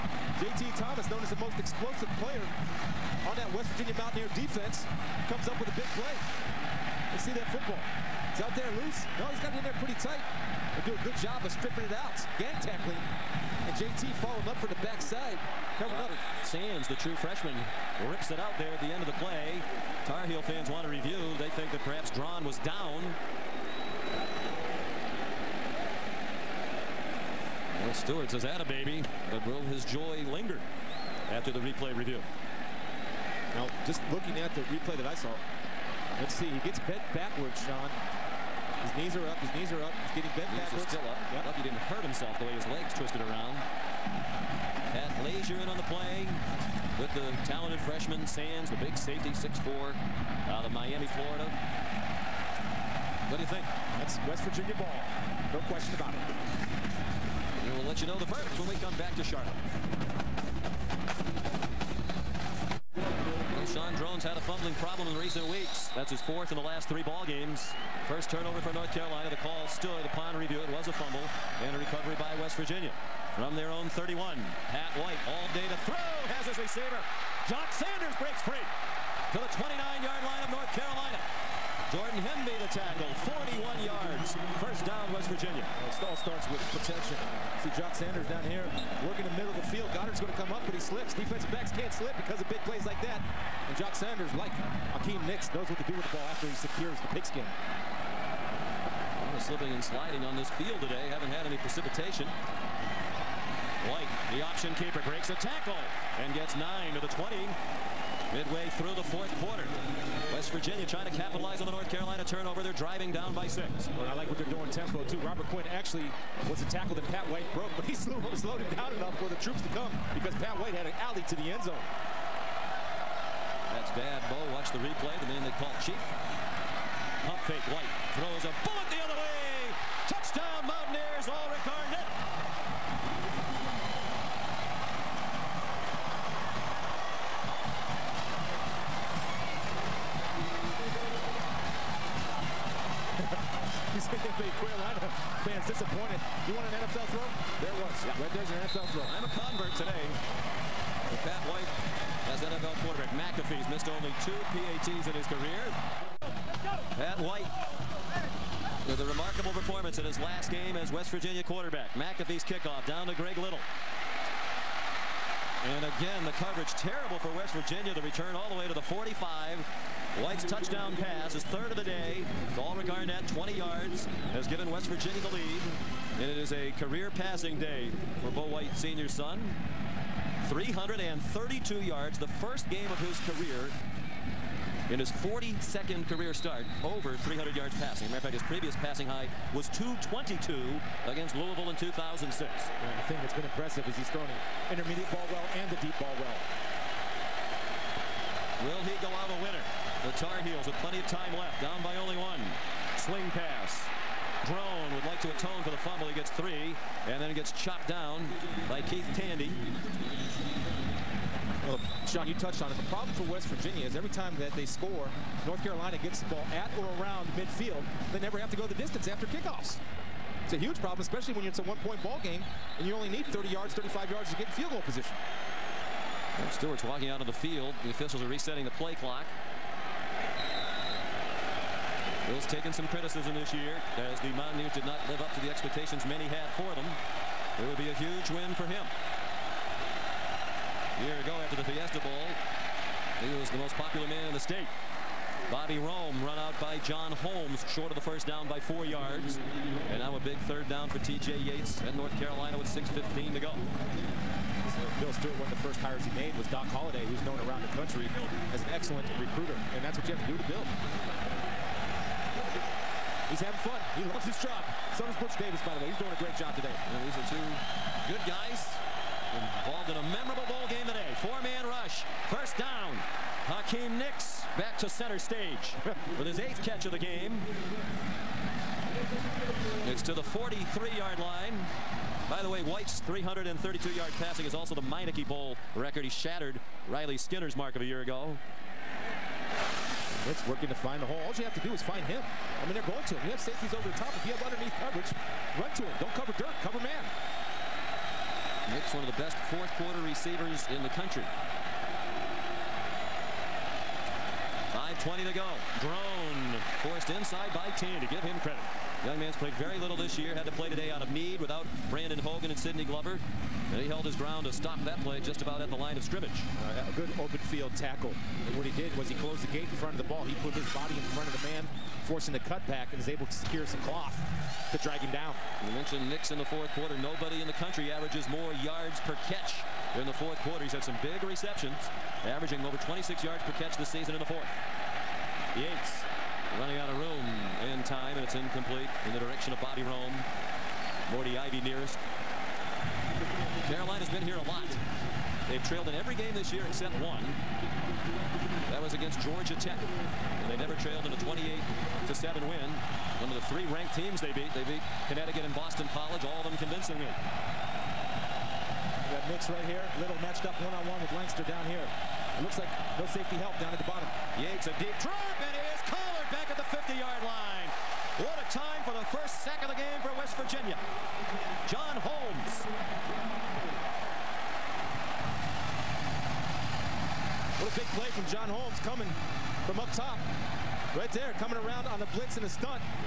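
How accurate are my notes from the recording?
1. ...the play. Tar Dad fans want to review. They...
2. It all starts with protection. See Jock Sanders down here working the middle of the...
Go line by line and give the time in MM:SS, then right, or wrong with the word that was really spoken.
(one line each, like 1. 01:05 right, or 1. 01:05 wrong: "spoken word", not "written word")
1. 00:19 wrong: "Heel", not "Dad"
2. 01:25 right.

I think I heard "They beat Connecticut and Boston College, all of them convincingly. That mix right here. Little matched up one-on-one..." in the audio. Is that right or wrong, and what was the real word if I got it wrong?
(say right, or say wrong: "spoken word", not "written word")
right.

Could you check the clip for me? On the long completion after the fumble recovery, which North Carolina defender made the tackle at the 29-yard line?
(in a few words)
Jordan Hemby.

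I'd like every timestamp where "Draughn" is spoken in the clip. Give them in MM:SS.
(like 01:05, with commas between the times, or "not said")
00:22, 01:03, 03:24, 05:05.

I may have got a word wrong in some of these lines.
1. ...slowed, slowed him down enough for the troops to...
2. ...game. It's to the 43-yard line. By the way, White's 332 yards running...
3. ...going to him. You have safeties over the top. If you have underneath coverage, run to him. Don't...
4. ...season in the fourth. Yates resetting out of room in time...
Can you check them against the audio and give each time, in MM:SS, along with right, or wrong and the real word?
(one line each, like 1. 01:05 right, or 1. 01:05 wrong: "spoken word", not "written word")
1. 01:57 right
2. 04:36 wrong: "passing", not "running"
3. 04:52 right
4. 05:33 wrong: "running", not "resetting".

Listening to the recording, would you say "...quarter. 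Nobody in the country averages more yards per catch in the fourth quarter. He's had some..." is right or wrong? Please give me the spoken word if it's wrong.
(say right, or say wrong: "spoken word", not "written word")
right.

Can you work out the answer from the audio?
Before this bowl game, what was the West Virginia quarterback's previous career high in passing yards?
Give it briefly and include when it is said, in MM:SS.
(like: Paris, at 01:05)
222, at 03:09.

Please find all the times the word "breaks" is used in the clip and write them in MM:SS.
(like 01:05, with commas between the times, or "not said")
01:18, 01:45.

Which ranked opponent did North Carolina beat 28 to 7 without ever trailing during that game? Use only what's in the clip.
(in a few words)
Georgia Tech.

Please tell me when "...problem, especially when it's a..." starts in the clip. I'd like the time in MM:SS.
03:40.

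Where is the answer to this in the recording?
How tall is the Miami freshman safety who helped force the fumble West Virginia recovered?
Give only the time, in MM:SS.
00:49.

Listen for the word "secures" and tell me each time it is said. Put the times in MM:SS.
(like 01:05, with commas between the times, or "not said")
01:36, 05:23.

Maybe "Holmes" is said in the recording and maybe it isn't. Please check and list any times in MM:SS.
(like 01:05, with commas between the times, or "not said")
04:07, 06:12, 06:18.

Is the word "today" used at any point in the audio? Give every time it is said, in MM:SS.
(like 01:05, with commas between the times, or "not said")
01:40, 02:29, 04:26, 04:30, 05:10.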